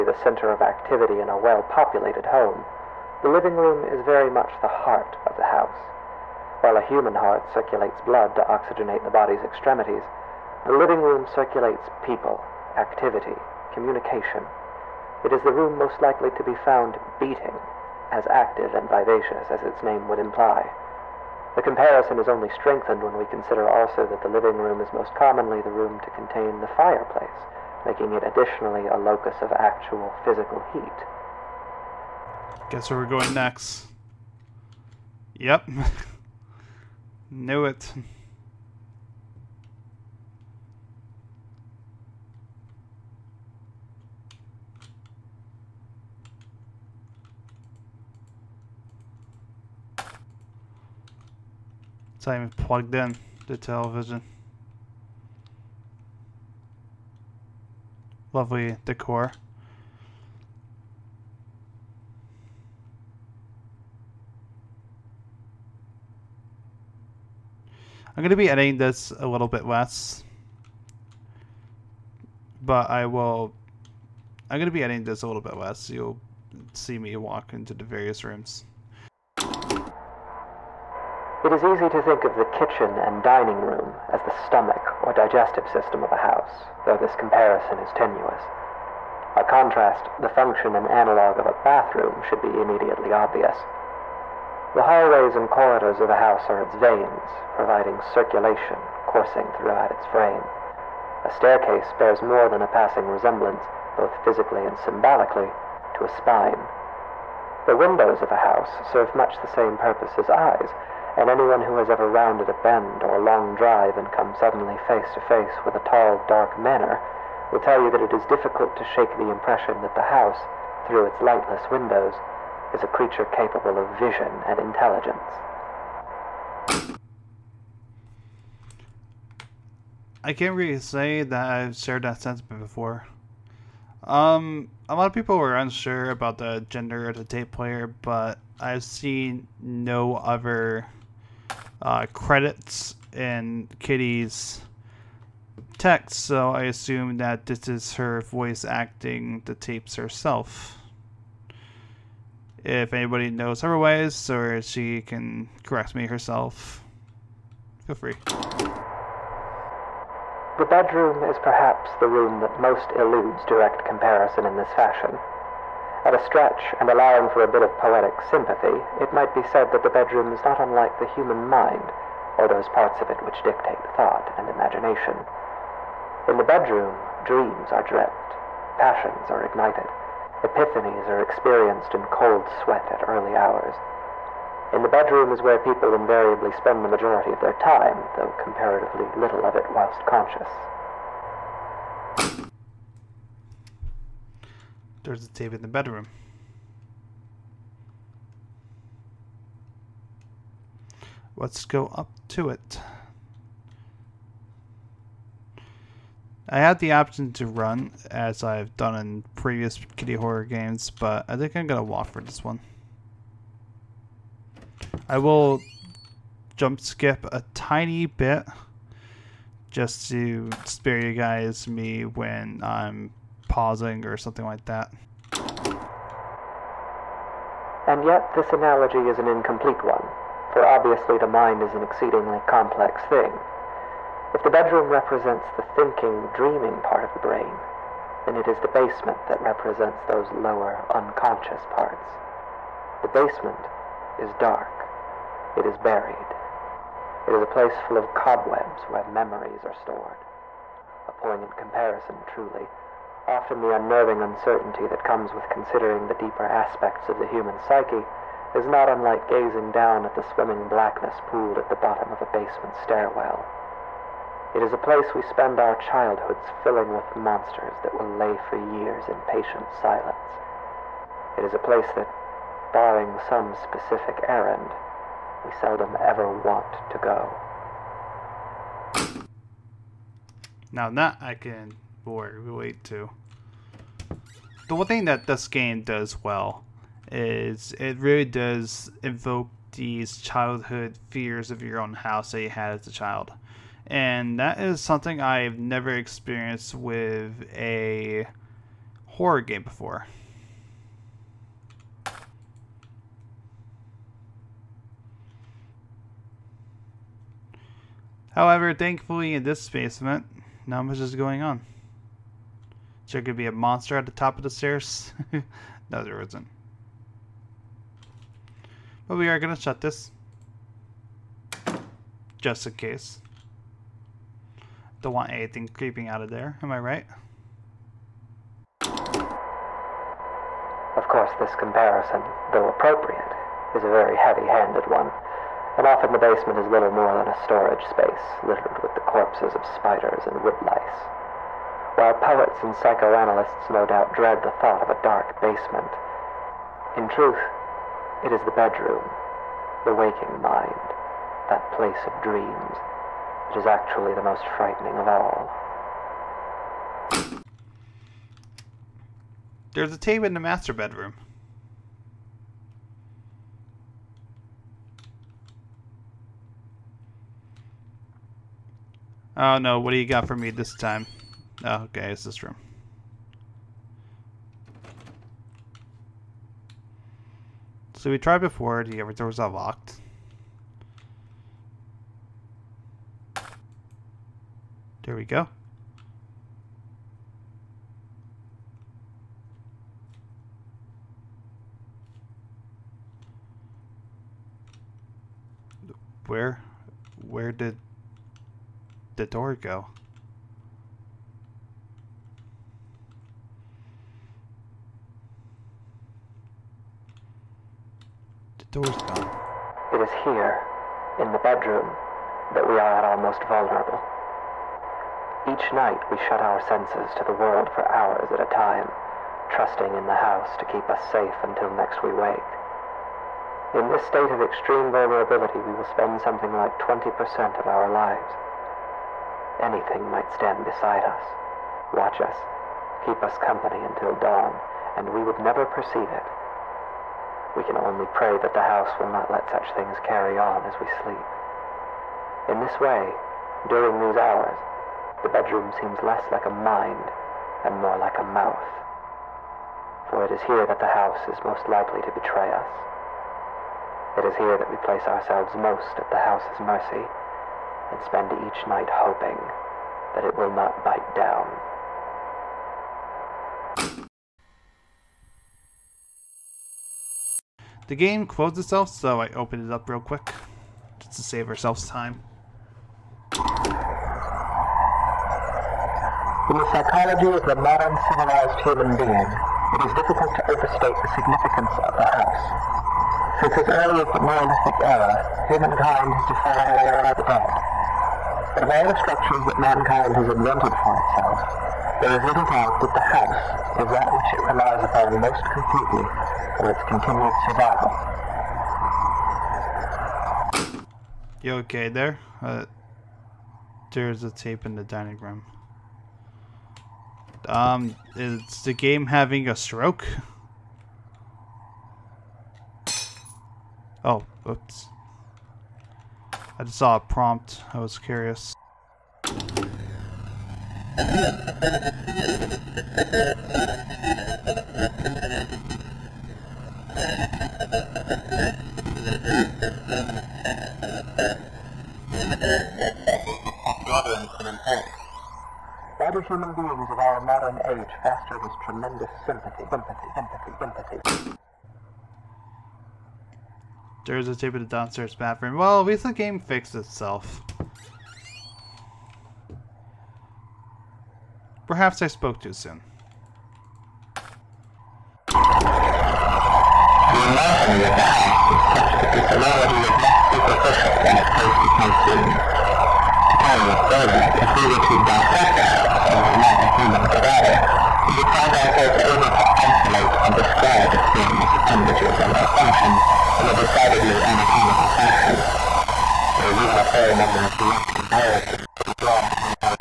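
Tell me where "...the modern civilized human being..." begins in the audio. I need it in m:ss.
7:57.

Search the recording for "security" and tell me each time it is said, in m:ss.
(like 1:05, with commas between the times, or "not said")
not said.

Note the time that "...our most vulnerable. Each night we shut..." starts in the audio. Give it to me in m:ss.
6:53.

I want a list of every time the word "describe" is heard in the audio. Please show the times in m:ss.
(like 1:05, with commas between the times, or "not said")
9:30.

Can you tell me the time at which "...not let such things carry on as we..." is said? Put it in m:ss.
7:19.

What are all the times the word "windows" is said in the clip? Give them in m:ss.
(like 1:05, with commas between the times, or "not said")
1:47, 2:01.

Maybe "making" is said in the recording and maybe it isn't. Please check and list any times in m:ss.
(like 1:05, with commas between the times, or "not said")
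0:27.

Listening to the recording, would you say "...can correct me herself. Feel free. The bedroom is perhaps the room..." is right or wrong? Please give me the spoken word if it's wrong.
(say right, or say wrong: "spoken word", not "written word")
right.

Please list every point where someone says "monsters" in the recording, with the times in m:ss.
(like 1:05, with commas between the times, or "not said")
4:27, 5:13.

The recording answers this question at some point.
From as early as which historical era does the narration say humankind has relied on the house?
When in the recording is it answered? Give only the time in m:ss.
8:04.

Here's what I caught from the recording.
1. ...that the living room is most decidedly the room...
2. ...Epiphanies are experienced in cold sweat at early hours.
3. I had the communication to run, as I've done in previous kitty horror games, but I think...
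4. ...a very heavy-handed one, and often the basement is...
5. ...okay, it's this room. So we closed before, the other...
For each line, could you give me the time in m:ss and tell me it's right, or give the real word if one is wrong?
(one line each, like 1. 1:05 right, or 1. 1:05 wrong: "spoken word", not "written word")
1. 0:24 wrong: "commonly", not "decidedly"
2. 3:00 right
3. 3:26 wrong: "option", not "communication"
4. 5:33 right
5. 6:11 wrong: "tried", not "closed".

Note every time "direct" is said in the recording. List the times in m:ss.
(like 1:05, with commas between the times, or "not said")
2:43, 9:37.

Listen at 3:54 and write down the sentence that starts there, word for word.
If the bedroom represents the thinking, dreaming part of the brain, then it is the basement that represents those lower, unconscious parts.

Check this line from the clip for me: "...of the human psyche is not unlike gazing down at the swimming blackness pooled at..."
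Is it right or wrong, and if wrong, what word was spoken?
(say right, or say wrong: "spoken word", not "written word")
right.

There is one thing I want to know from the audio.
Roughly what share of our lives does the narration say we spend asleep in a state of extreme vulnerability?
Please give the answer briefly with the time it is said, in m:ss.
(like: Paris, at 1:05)
20%, at 7:06.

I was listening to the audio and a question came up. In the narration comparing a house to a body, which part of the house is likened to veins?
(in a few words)
hallways and corridors.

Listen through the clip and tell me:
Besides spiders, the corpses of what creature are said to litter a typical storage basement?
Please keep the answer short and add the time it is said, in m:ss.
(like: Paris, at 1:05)
woodlice, at 5:40.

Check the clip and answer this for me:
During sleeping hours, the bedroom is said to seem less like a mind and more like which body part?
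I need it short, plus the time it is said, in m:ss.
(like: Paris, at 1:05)
mouth, at 7:28.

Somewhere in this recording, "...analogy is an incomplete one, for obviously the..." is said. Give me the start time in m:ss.
3:48.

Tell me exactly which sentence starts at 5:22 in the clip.
Just in case don't want anything creeping out of there.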